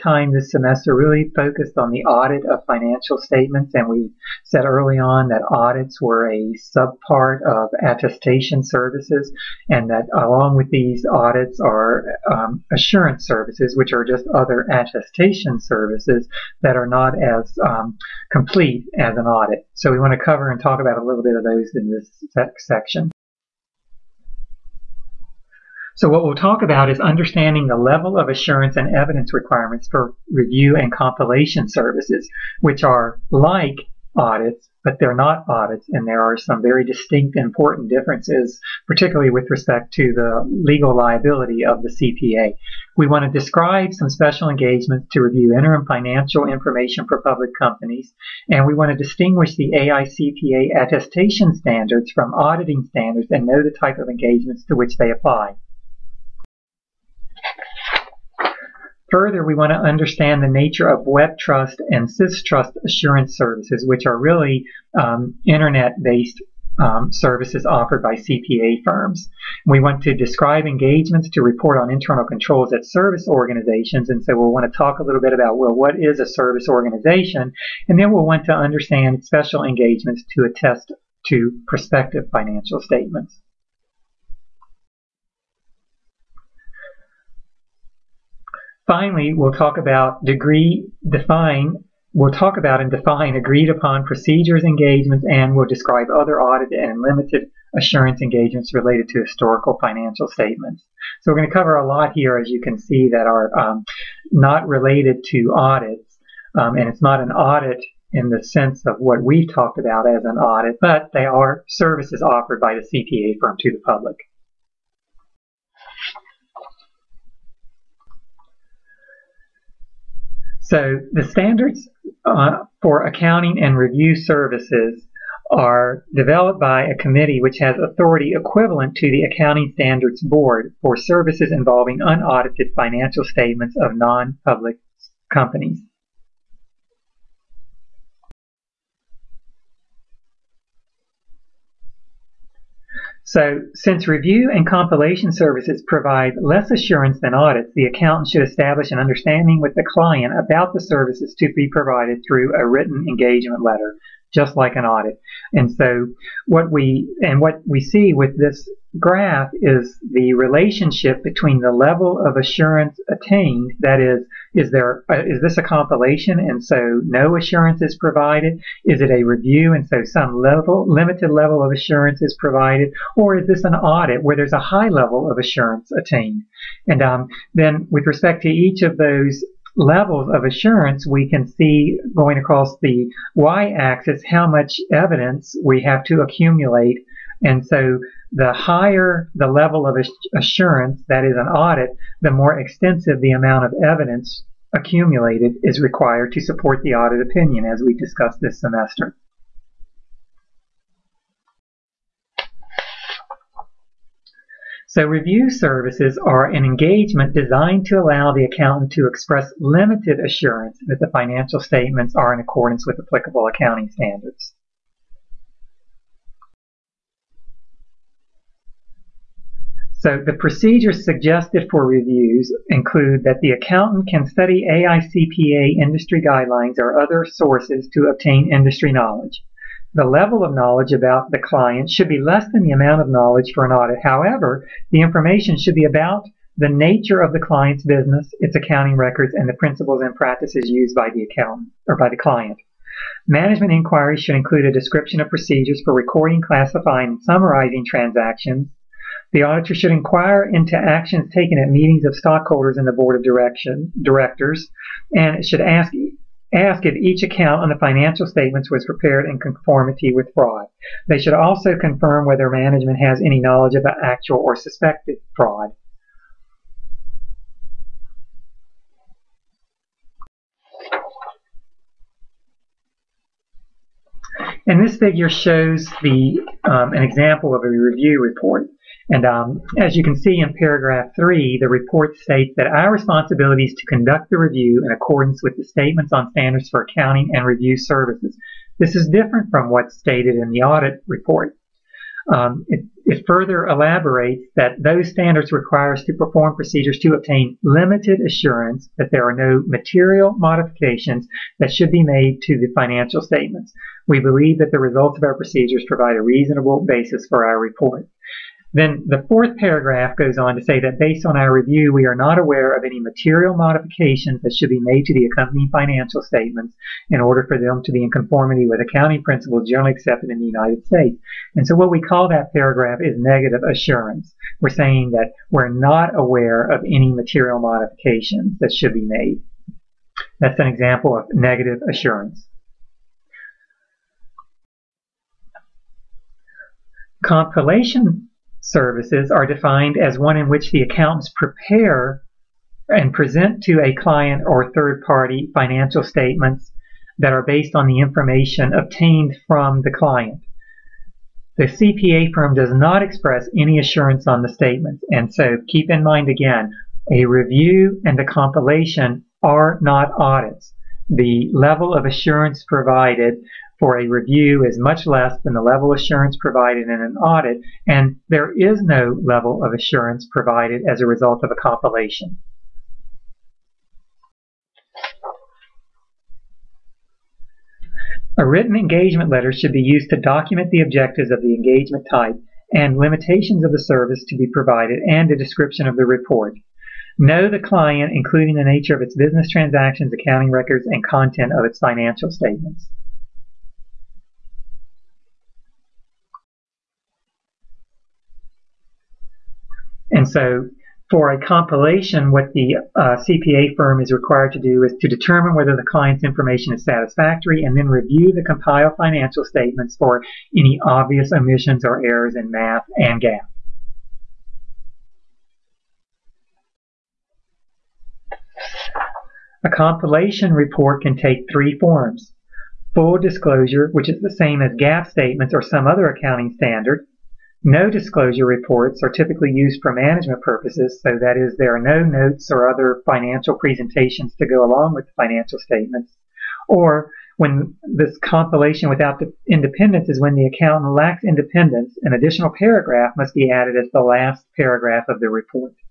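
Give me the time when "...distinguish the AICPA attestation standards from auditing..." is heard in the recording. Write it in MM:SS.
00:48.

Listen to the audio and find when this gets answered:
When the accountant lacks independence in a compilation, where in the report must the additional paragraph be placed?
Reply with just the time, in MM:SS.
07:24.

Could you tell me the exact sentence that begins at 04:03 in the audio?
Management inquiries should include a description of procedures for recording, classifying, and summarizing transactions.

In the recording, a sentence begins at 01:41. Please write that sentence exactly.
So we're going to cover a lot here, as you can see, that are um, not related to audits.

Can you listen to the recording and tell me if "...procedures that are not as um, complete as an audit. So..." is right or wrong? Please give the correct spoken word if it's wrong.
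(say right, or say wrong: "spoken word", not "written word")
wrong: "services", not "procedures".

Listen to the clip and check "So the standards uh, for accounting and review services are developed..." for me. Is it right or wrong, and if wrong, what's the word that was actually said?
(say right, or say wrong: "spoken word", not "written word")
right.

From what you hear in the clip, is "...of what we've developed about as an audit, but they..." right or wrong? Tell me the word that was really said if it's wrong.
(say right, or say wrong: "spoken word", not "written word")
wrong: "talked", not "developed".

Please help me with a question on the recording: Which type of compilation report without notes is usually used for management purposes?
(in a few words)
no disclosure.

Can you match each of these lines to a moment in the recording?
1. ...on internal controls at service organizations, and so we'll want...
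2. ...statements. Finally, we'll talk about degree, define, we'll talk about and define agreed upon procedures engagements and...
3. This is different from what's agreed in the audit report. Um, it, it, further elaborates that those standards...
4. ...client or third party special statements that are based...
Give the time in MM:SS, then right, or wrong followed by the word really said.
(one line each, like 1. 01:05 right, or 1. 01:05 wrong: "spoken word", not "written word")
1. 01:11 right
2. 01:22 right
3. 04:48 wrong: "stated", not "agreed"
4. 05:43 wrong: "financial", not "special".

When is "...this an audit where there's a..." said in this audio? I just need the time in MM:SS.
02:53.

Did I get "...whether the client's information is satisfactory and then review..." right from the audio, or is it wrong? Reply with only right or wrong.
right.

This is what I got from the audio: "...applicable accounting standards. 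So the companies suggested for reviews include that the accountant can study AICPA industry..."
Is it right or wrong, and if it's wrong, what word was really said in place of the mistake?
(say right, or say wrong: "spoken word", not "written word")
wrong: "procedures", not "companies".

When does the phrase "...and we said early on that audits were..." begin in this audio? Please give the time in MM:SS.
00:03.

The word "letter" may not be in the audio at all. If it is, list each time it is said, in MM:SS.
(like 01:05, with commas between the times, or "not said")
02:33, 06:19.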